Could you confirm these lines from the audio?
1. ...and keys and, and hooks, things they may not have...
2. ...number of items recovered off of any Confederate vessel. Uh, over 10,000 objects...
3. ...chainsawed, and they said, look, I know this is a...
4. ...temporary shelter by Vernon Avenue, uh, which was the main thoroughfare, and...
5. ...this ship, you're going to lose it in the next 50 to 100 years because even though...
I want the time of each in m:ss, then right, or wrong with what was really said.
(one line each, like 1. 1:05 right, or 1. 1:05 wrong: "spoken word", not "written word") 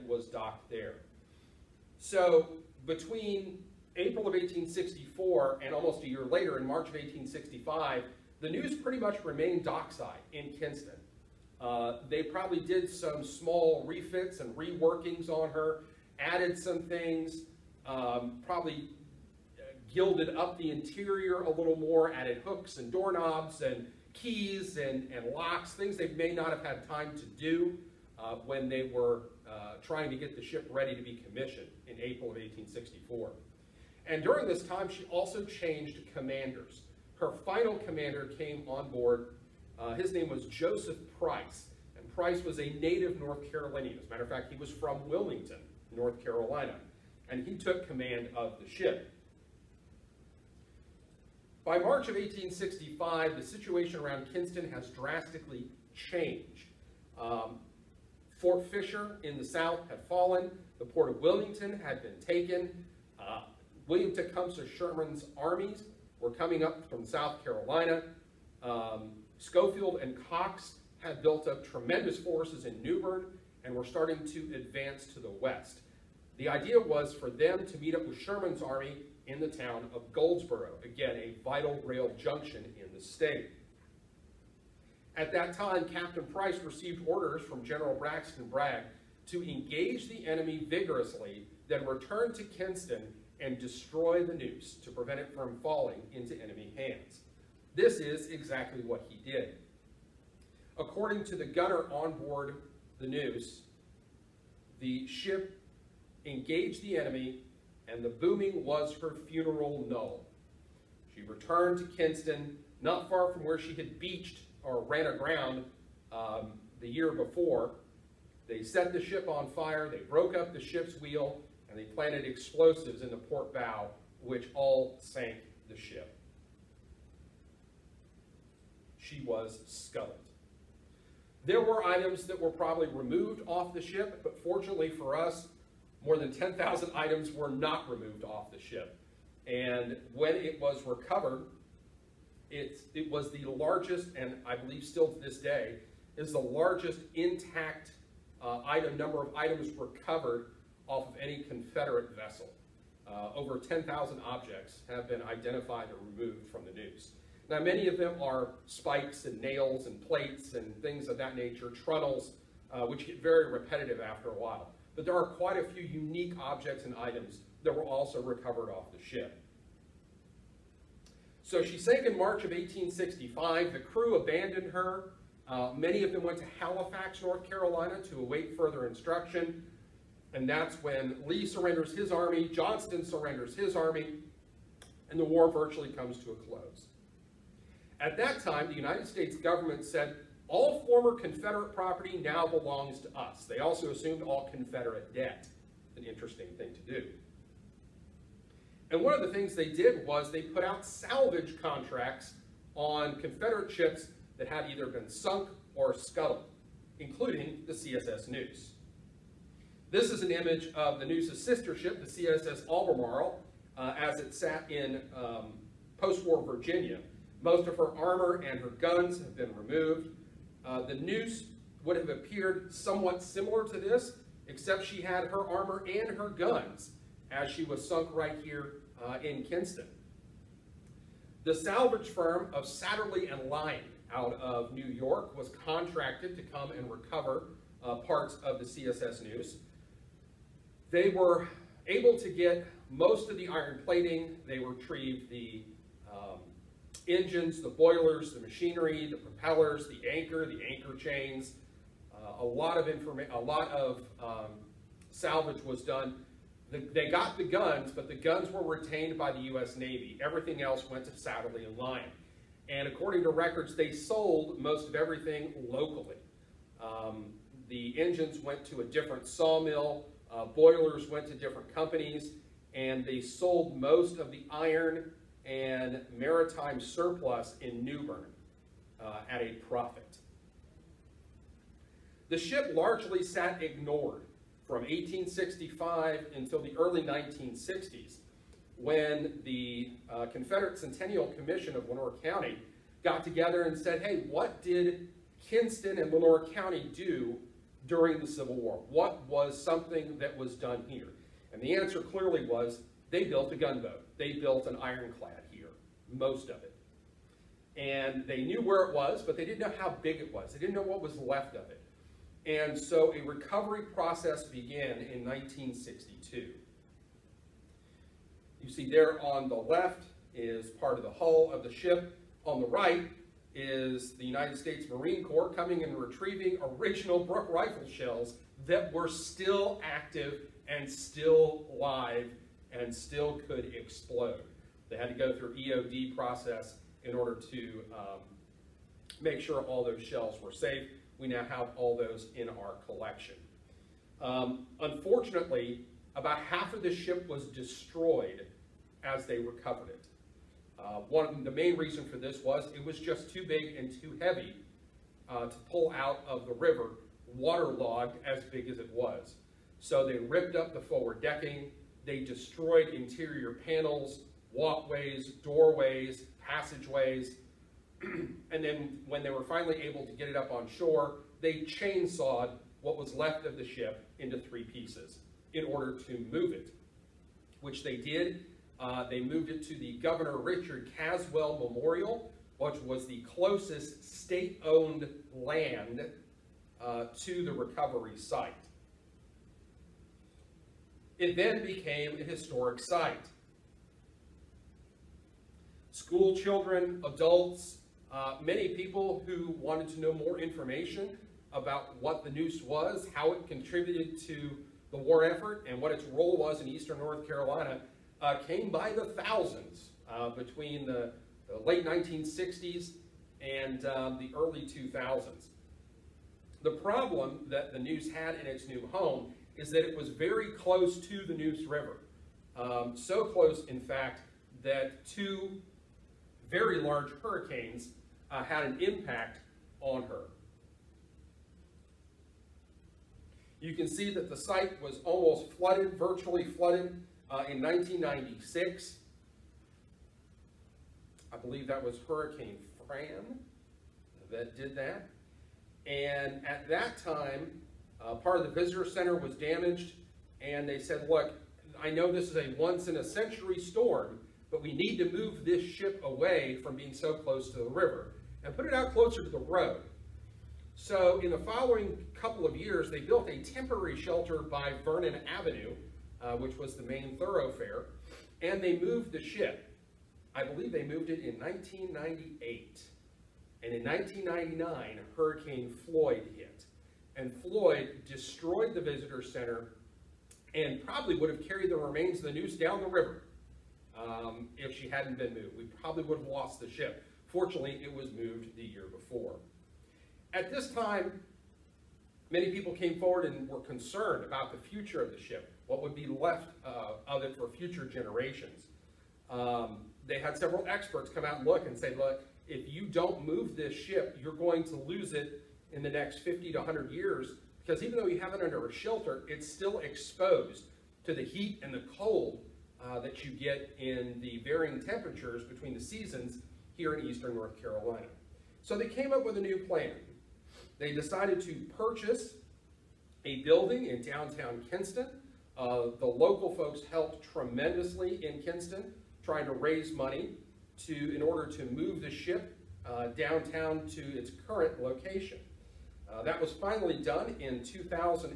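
1. 0:23 wrong: "locks", not "hooks"
2. 2:28 right
3. 7:29 wrong: "damaged", not "chainsawed"
4. 7:43 right
5. 8:23 right.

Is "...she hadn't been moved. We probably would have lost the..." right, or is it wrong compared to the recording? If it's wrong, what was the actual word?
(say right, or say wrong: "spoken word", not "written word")
right.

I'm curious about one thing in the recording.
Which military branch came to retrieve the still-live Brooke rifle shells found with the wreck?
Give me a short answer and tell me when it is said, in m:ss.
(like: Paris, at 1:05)
United States Marine Corps, at 5:24.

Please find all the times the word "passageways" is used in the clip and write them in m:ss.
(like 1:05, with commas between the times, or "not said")
6:06.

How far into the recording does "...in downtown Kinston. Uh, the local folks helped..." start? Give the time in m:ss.
8:43.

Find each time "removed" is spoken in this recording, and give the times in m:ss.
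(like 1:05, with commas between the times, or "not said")
2:12, 2:17, 2:36, 3:39.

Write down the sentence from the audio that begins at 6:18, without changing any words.
Uh, they moved it to the Governor Richard Caswell Memorial, which was the closest state-owned land uh, to the recovery site.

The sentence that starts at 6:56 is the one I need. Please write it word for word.
The problem that the Neuse had in its new home is that it was very close to the Neuse River.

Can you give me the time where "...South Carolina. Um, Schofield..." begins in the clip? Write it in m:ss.
1:07.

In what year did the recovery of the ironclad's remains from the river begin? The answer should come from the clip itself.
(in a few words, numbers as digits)
1962.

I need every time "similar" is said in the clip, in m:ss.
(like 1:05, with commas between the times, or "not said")
3:43.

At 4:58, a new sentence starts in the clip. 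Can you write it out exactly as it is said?
What was something that was done here?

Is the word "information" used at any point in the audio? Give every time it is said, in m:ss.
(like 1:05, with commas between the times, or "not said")
4:12, 6:40.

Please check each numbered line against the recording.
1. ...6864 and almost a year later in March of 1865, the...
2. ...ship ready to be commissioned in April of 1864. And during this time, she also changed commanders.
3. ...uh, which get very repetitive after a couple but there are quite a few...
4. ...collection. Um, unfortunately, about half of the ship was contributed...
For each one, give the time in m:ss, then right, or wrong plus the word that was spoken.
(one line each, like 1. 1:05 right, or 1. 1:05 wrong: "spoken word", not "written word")
1. 0:04 wrong: "1864", not "6864"
2. 0:30 right
3. 2:42 wrong: "while", not "couple"
4. 5:42 wrong: "destroyed", not "contributed".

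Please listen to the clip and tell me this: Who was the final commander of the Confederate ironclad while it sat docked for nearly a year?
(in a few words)
Joseph Price.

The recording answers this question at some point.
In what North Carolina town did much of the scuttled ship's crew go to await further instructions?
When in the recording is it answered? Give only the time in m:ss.
2:56.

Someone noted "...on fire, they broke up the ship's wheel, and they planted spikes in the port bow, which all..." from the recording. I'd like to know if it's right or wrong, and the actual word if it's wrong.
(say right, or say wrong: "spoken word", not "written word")
wrong: "explosives", not "spikes".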